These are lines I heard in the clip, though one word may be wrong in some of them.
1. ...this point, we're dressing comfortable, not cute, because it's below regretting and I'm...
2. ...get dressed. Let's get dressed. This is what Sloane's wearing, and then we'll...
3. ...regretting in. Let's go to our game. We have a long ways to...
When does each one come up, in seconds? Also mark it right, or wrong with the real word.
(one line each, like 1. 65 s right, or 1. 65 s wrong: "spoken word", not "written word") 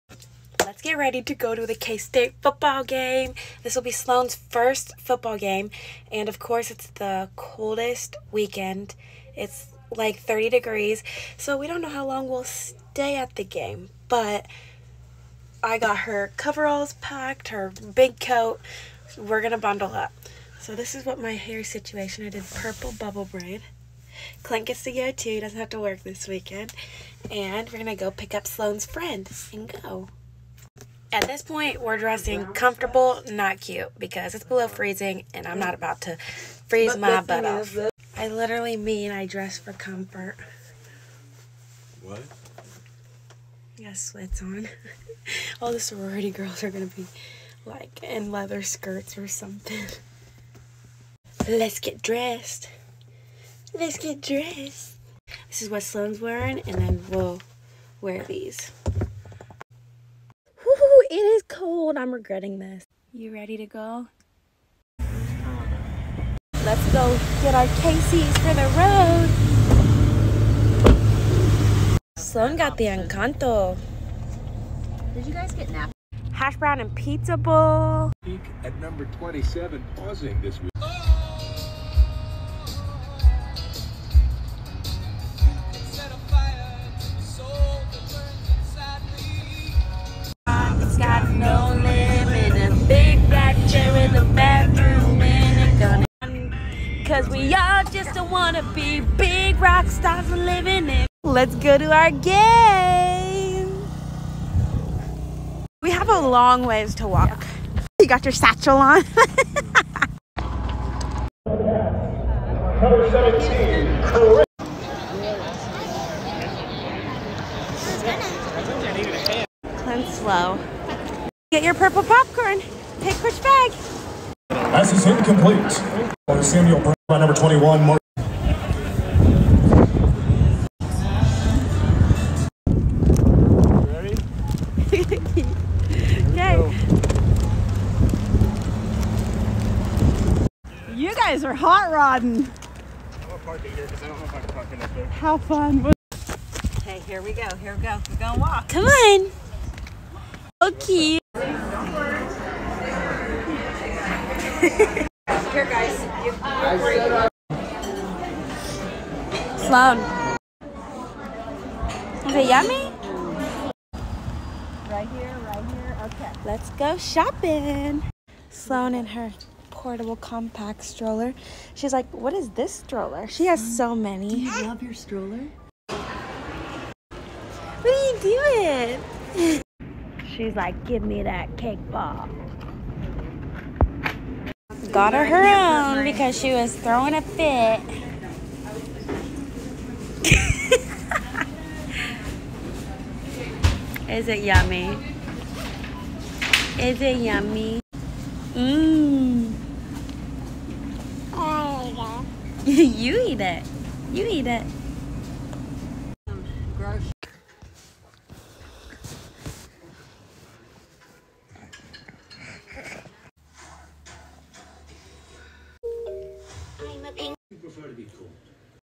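1. 31 s wrong: "freezing", not "regretting"
2. 51 s right
3. 100 s wrong: "living", not "regretting".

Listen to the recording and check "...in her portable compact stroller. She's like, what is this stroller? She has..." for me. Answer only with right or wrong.
right.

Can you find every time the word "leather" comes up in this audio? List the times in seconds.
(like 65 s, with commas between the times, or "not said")
48 s.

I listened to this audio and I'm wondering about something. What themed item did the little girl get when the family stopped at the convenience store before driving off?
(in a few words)
Encanto.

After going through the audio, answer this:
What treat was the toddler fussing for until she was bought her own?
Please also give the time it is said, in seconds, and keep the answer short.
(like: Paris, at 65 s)
cake ball, at 181 s.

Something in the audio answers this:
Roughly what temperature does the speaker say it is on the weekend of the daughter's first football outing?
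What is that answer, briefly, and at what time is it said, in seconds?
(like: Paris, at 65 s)
30 degrees, at 10 s.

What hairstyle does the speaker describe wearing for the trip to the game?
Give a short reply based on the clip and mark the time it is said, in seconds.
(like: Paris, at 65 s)
purple bubble braid, at 22 s.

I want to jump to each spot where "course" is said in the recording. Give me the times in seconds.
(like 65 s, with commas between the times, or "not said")
6 s.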